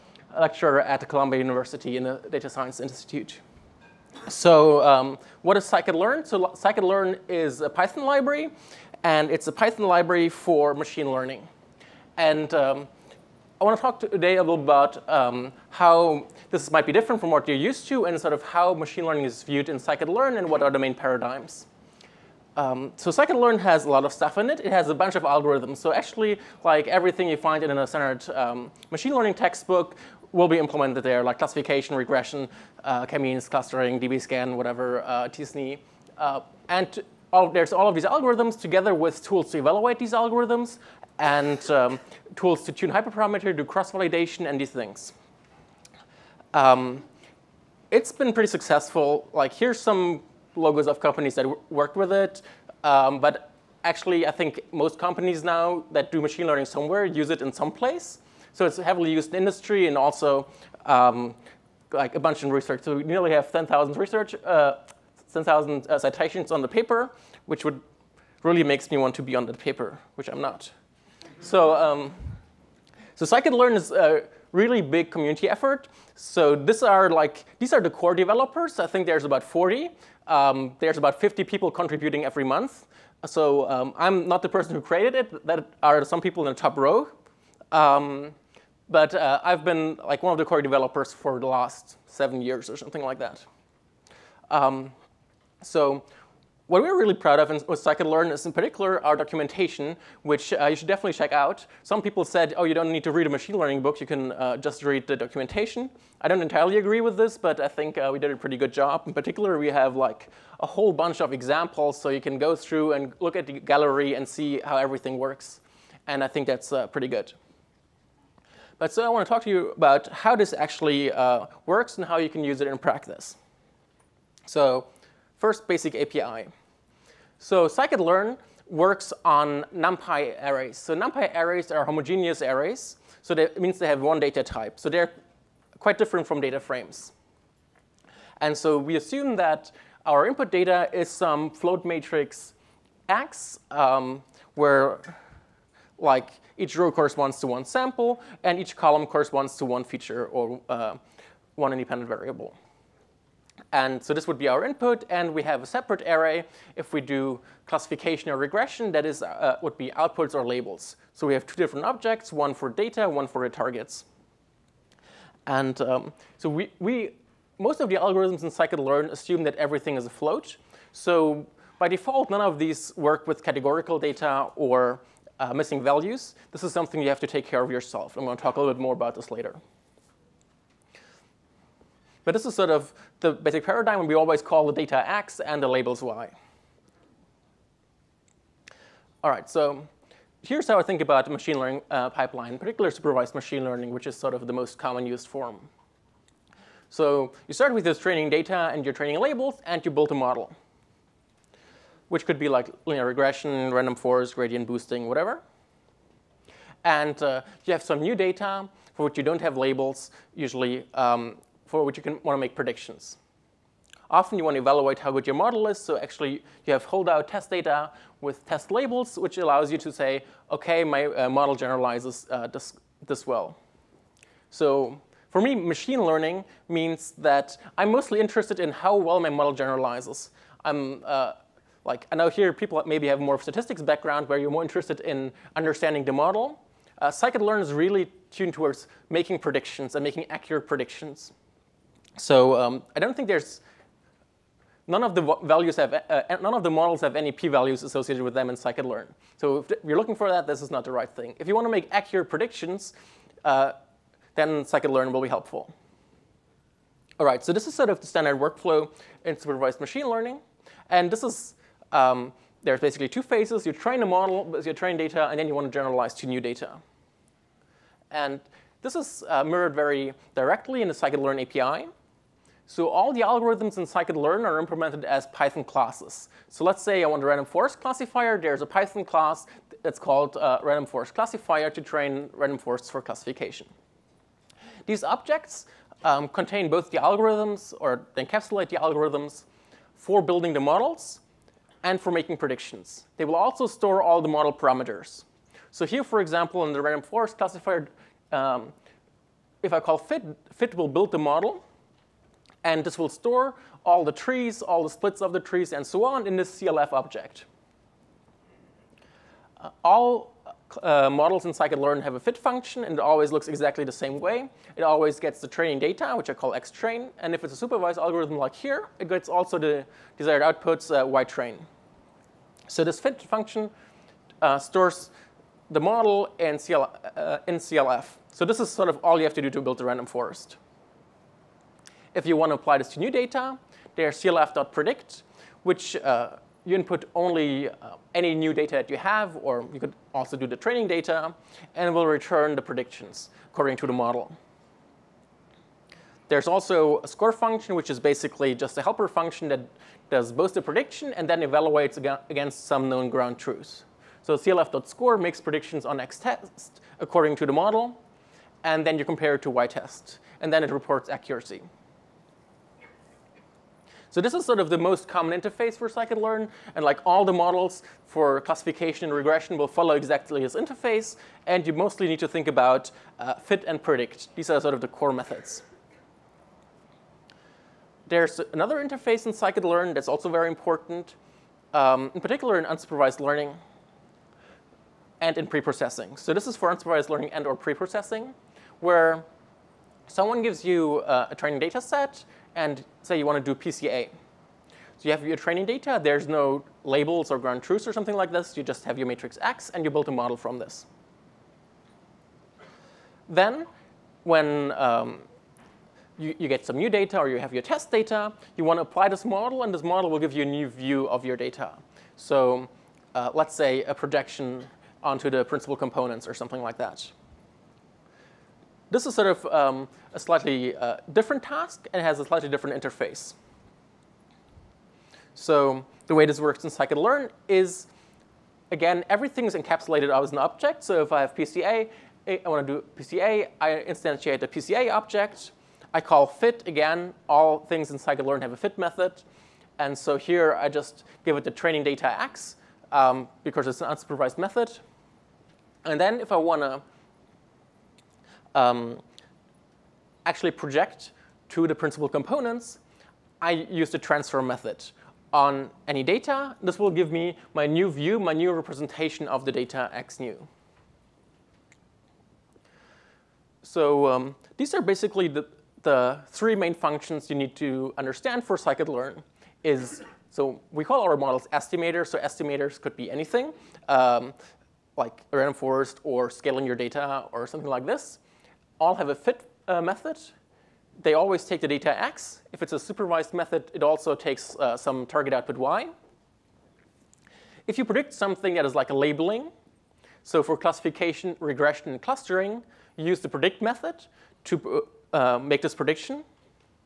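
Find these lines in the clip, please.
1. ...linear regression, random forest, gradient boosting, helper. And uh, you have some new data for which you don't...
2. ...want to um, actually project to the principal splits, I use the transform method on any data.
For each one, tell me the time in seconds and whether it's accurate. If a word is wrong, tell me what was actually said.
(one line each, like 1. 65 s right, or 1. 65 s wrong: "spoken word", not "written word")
1. 202 s wrong: "whatever", not "helper"
2. 446 s wrong: "components", not "splits".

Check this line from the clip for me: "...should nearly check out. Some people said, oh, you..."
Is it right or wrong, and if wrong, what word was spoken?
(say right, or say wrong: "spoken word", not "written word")
wrong: "definitely", not "nearly".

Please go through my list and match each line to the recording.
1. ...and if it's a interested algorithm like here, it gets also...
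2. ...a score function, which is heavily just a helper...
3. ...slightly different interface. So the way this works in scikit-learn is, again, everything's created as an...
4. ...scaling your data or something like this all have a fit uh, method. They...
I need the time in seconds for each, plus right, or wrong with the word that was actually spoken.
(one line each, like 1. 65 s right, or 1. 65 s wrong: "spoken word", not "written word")
1. 317 s wrong: "supervised", not "interested"
2. 347 s wrong: "basically", not "heavily"
3. 422 s wrong: "encapsulated", not "created"
4. 476 s right.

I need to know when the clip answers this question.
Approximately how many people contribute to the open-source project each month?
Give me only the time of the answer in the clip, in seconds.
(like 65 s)
80 s.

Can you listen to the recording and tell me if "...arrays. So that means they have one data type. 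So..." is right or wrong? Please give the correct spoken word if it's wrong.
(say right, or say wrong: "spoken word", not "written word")
right.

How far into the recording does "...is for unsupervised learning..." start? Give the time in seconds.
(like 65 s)
386 s.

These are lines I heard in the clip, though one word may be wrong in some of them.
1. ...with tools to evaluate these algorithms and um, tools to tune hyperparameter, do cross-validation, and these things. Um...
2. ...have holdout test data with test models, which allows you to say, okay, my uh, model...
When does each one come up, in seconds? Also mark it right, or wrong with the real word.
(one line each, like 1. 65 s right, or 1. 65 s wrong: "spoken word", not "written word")
1. 38 s right
2. 216 s wrong: "labels", not "models".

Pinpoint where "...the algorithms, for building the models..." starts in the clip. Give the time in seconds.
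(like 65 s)
288 s.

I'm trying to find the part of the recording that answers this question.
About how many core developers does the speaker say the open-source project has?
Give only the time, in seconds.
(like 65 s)
79 s.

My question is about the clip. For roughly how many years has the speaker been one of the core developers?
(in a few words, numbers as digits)
7.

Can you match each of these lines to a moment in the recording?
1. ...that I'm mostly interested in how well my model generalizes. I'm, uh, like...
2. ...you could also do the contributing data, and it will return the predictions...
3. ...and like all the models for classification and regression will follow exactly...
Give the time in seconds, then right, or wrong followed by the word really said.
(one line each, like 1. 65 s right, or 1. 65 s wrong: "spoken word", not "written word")
1. 227 s right
2. 339 s wrong: "training", not "contributing"
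3. 366 s right.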